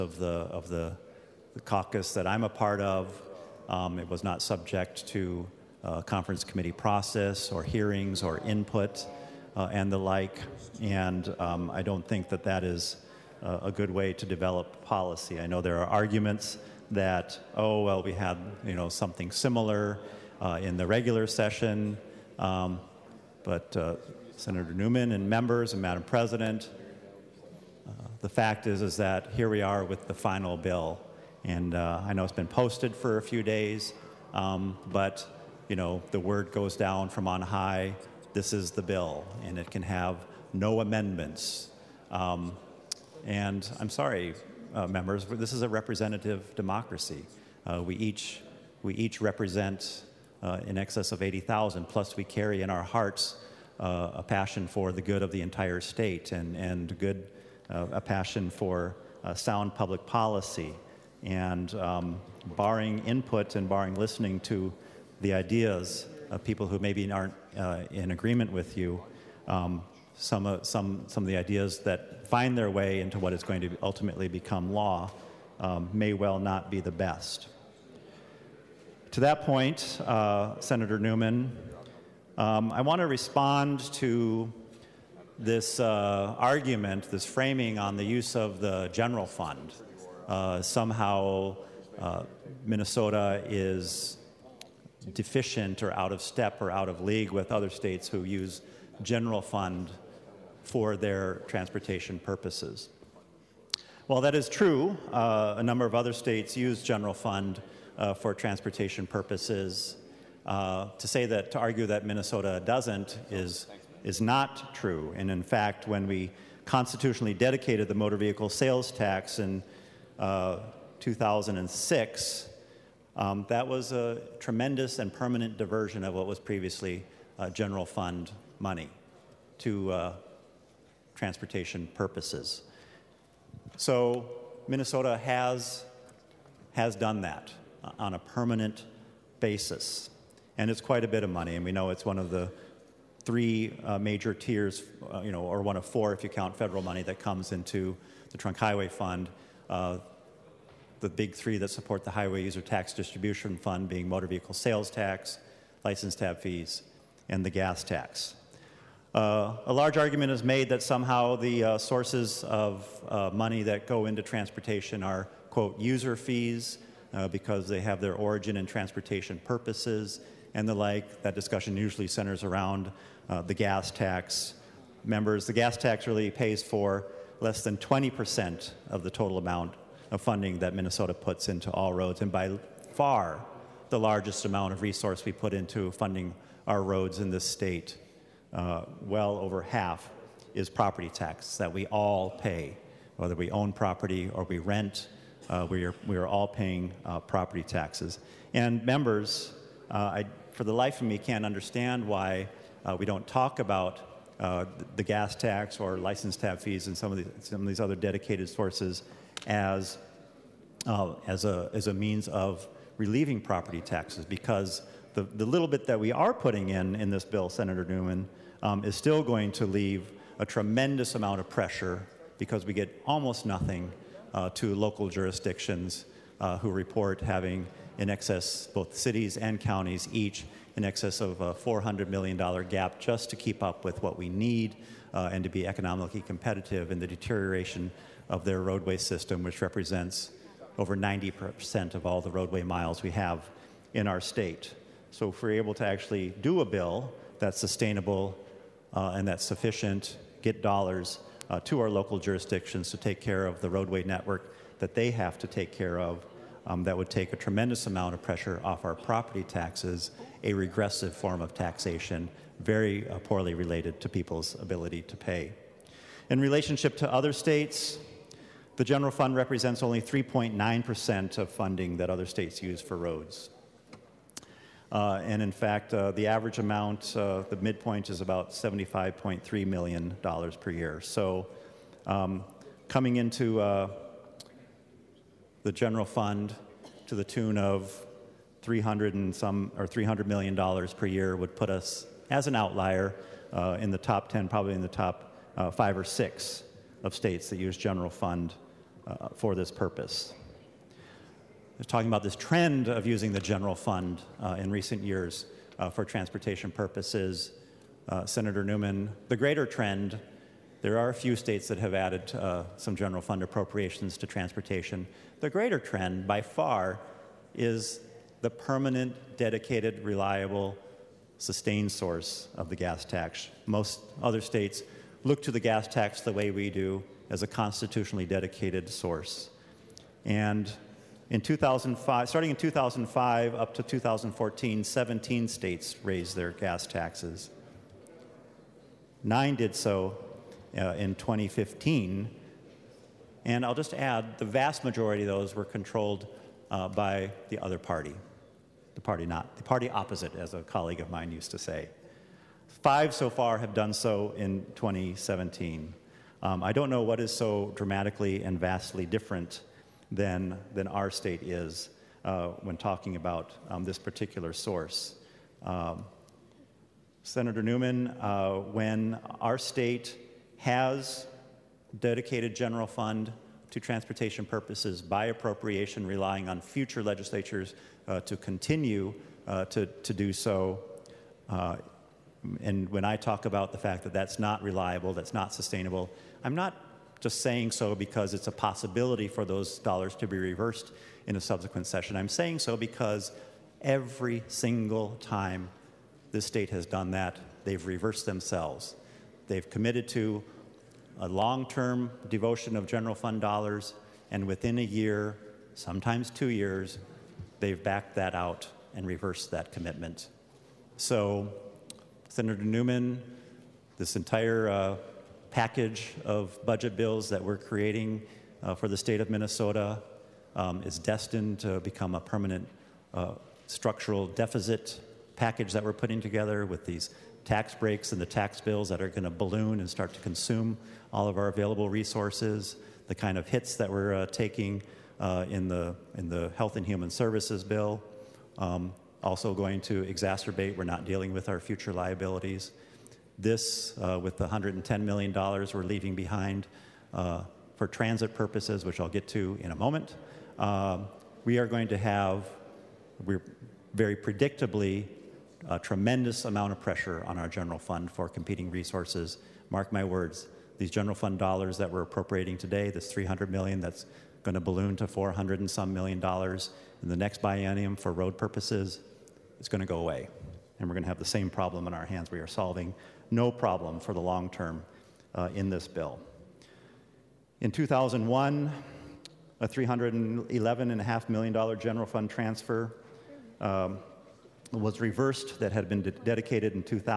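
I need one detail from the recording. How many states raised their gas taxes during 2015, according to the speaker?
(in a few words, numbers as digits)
9.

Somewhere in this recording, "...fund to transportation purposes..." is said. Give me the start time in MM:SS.
06:12.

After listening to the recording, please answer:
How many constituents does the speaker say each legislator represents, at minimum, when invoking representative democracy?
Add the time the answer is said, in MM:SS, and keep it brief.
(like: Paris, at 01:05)
80,000, at 00:51.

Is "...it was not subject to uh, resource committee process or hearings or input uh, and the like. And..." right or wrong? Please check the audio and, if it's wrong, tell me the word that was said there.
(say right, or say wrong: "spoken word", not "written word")
wrong: "conference", not "resource".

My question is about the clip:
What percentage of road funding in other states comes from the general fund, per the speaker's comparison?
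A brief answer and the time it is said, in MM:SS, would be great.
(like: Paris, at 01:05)
3.9%, at 04:30.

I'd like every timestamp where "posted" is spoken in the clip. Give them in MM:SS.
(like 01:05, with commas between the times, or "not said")
00:32.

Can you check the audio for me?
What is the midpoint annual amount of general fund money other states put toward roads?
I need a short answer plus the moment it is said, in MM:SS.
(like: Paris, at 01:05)
$75.3 million, at 04:38.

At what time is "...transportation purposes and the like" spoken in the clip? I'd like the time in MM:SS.
02:48.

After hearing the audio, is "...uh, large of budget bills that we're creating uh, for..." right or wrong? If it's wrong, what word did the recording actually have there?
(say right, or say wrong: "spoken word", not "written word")
wrong: "package", not "large".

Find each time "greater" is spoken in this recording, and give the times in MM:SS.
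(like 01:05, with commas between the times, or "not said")
05:09, 05:15.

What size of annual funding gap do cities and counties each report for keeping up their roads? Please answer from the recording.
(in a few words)
$400 million.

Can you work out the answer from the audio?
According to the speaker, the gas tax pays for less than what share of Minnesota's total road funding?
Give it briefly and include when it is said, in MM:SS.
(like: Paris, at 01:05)
20%, at 02:57.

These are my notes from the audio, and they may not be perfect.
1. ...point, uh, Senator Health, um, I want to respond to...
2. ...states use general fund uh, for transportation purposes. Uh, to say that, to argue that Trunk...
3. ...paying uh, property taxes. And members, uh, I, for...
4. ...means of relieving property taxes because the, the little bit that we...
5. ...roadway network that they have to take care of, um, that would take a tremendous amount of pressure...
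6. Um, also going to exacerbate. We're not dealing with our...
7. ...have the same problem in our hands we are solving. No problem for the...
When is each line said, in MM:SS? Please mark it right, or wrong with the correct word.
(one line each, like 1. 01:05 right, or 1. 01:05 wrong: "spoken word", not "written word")
1. 01:19 wrong: "Newman", not "Health"
2. 01:46 wrong: "Minnesota", not "Trunk"
3. 03:16 right
4. 03:31 right
5. 04:13 right
6. 07:18 right
7. 07:51 right.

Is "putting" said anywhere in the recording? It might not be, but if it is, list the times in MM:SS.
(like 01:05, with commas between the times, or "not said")
03:36, 07:05.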